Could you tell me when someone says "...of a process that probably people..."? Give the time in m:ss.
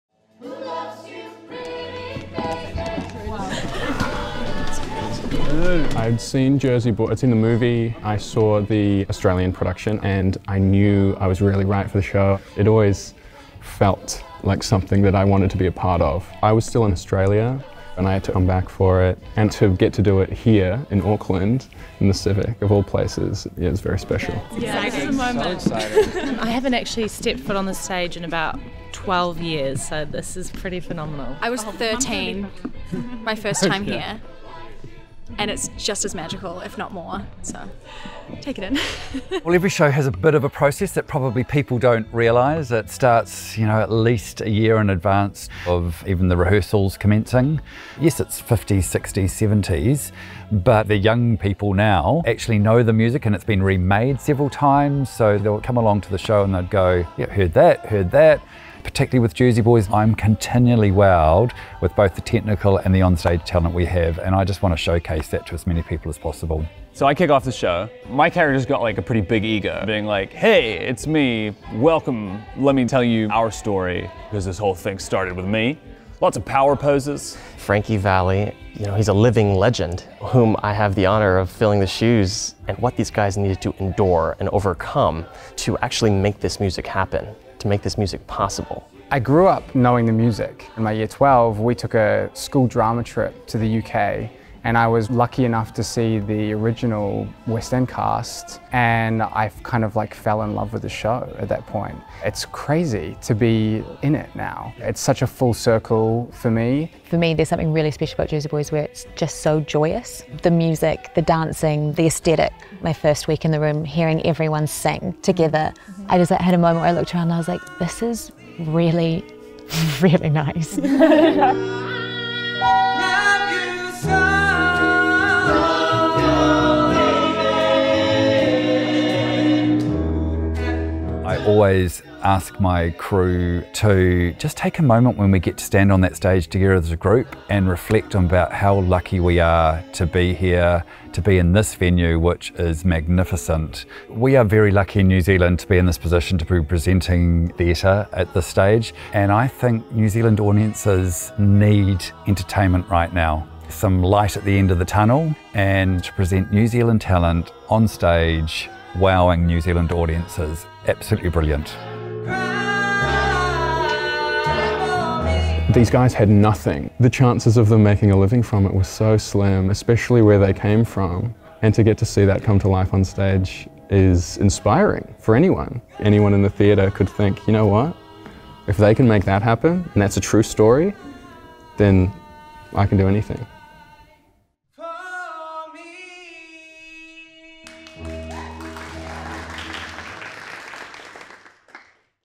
0:40.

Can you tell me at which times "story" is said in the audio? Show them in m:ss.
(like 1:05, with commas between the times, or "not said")
1:13, 3:00.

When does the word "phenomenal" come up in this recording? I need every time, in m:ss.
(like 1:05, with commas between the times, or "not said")
0:30.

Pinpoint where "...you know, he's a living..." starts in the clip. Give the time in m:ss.
1:18.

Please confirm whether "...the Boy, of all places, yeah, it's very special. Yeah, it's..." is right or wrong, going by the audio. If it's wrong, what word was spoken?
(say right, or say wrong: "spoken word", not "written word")
wrong: "Civic", not "Boy".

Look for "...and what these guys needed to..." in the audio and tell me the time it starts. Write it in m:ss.
1:22.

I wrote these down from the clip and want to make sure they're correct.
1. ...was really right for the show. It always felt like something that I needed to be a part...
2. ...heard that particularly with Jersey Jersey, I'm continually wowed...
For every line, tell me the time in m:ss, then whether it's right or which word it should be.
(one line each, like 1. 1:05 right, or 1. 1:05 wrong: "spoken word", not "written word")
1. 0:11 wrong: "wanted", not "needed"
2. 0:57 wrong: "Boys", not "Jersey".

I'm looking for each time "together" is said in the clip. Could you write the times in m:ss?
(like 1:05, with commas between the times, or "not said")
1:55, 2:16.